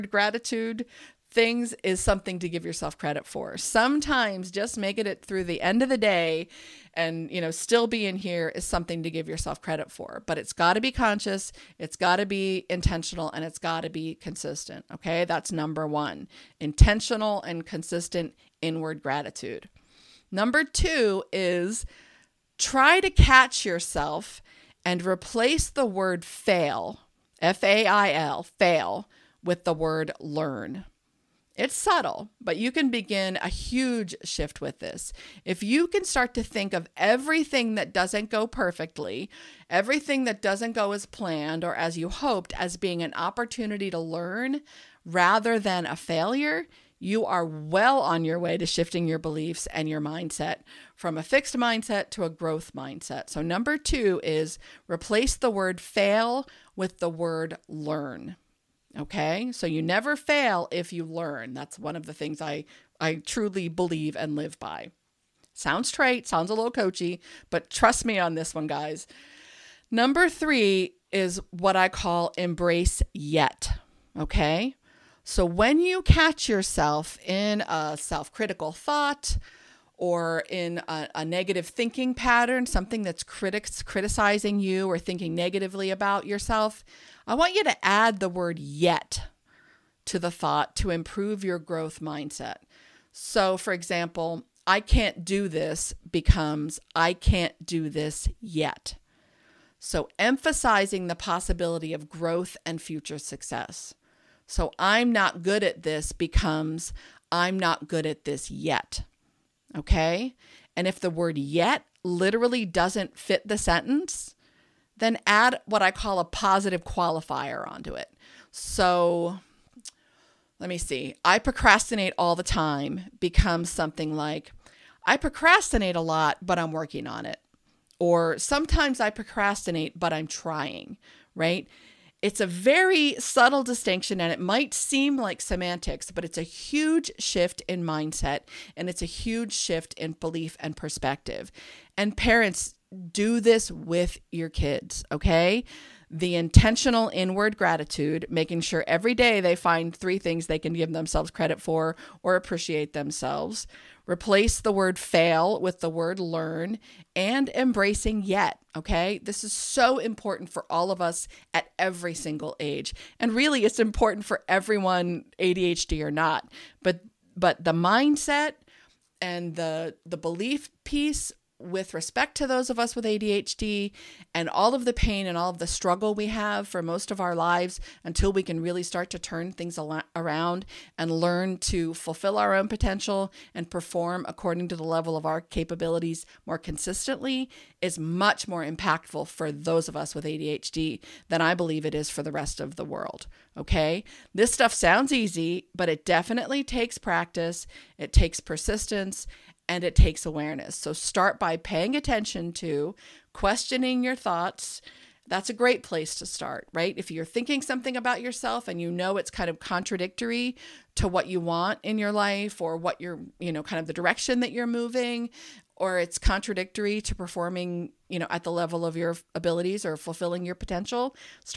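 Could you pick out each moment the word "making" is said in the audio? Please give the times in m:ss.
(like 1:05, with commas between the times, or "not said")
0:04, 2:28.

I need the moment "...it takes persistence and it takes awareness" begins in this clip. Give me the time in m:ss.
3:17.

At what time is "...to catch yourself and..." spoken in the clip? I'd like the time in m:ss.
0:22.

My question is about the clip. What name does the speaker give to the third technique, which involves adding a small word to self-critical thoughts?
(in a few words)
embrace yet.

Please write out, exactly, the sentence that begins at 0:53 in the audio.
So, number two is replace the word fail with the word learn.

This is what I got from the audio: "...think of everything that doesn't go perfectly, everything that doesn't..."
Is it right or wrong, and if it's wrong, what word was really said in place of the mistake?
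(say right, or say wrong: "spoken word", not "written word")
right.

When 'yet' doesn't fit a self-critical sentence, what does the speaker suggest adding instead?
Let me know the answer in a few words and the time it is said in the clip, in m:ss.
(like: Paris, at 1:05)
positive qualifier, at 1:56.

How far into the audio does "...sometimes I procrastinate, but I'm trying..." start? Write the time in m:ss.
2:08.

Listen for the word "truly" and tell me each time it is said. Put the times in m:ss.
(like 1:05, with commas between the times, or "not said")
1:03.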